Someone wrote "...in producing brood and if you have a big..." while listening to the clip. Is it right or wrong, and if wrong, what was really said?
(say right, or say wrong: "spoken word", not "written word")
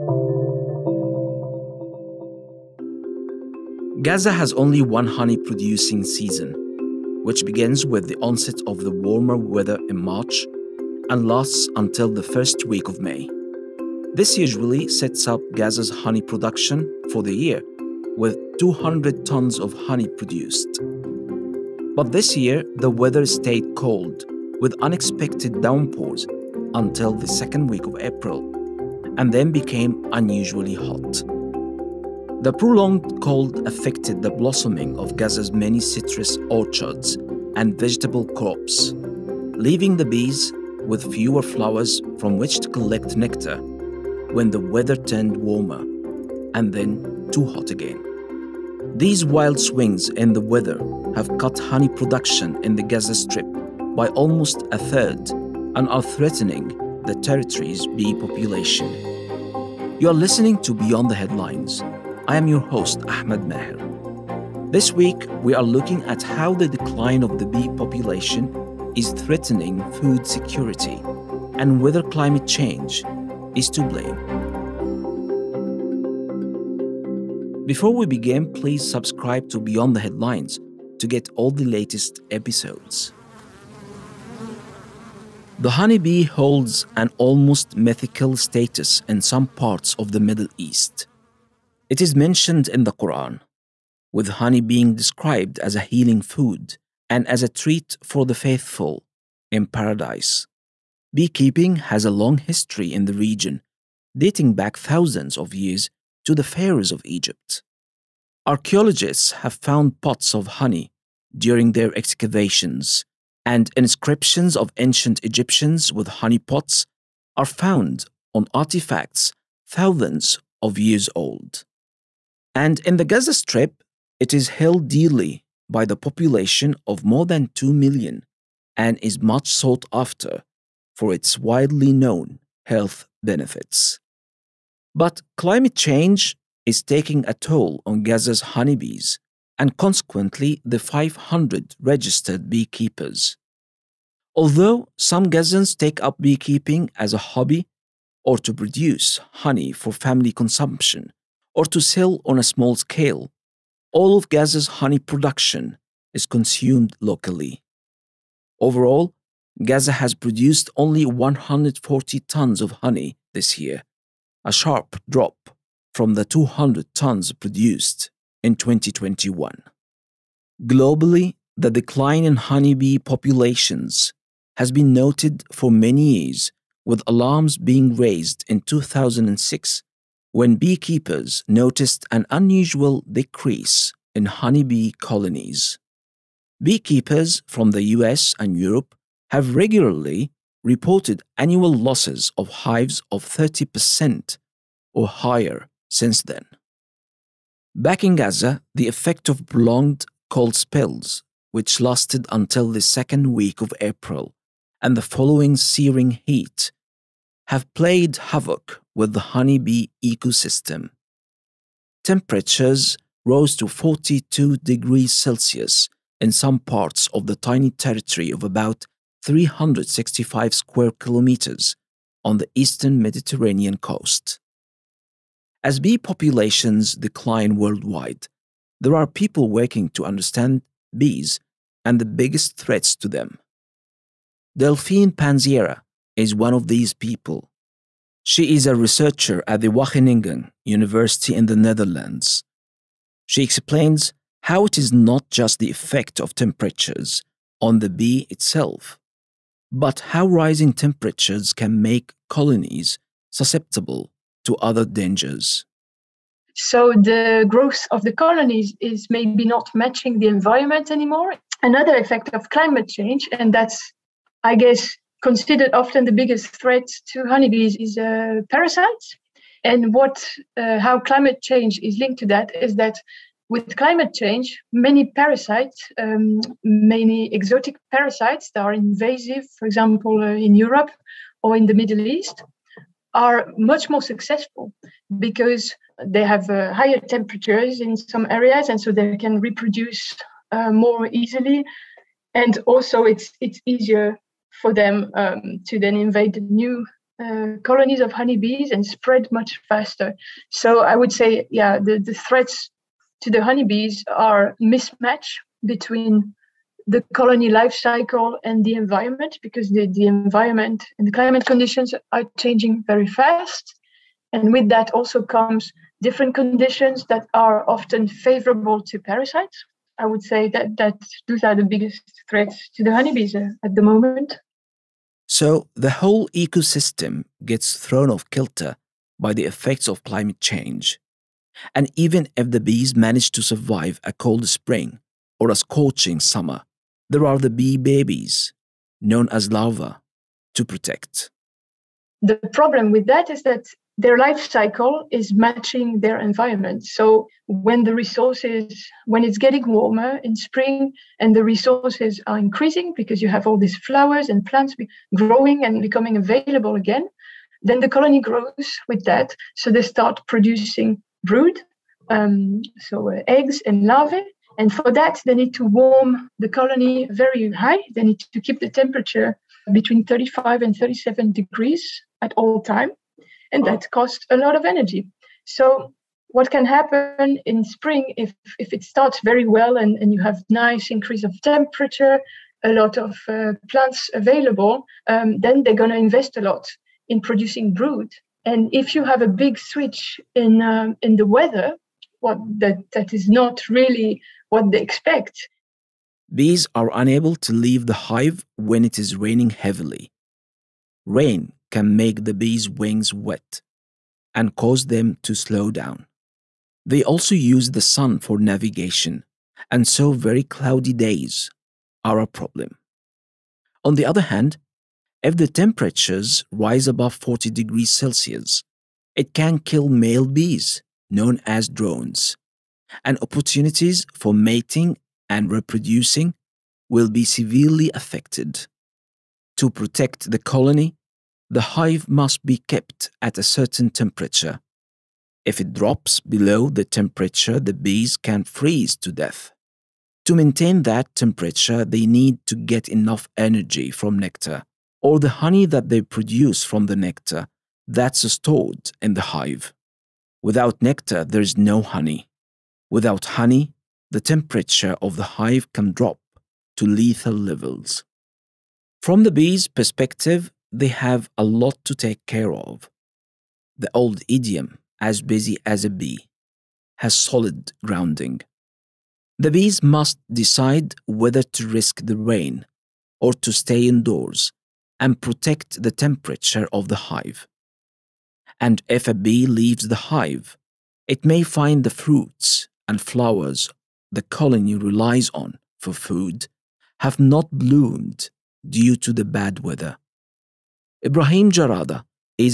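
right.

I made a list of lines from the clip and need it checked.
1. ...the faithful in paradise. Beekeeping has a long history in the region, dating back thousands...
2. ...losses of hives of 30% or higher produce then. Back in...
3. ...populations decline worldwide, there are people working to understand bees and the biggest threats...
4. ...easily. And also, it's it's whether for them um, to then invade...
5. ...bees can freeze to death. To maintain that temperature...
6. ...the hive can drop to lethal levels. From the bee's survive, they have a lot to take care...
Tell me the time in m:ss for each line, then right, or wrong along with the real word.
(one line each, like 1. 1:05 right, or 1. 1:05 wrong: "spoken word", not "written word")
1. 1:38 right
2. 3:11 wrong: "since", not "produce"
3. 3:45 right
4. 4:51 wrong: "easier", not "whether"
5. 7:17 right
6. 7:35 wrong: "perspective", not "survive".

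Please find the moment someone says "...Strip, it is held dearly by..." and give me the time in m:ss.
2:03.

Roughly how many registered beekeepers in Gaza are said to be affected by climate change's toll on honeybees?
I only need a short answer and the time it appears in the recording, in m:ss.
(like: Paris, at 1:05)
500, at 2:20.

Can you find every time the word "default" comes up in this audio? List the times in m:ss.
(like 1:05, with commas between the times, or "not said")
not said.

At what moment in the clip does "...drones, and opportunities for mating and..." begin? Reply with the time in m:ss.
7:01.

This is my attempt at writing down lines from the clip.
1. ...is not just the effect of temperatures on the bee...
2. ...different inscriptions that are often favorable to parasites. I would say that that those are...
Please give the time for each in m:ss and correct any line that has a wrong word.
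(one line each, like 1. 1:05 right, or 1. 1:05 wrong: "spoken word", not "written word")
1. 4:04 right
2. 5:16 wrong: "conditions", not "inscriptions".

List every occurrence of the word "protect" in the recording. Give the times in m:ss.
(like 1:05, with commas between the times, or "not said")
5:40, 7:09, 7:55.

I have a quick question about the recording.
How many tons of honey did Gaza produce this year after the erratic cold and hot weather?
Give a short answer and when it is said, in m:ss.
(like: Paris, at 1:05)
140 tons, at 2:41.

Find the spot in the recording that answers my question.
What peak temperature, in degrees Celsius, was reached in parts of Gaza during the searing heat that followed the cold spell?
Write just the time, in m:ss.
3:33.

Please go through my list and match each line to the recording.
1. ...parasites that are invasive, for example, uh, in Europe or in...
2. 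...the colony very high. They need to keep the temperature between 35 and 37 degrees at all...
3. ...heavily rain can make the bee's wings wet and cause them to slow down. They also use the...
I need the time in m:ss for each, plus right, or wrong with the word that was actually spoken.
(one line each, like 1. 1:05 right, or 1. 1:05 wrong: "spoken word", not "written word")
1. 4:37 right
2. 6:06 right
3. 6:39 right.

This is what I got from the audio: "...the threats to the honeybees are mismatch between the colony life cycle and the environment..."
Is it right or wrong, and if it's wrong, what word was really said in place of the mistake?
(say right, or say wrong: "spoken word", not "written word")
right.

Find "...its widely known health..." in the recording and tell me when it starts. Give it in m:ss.
2:11.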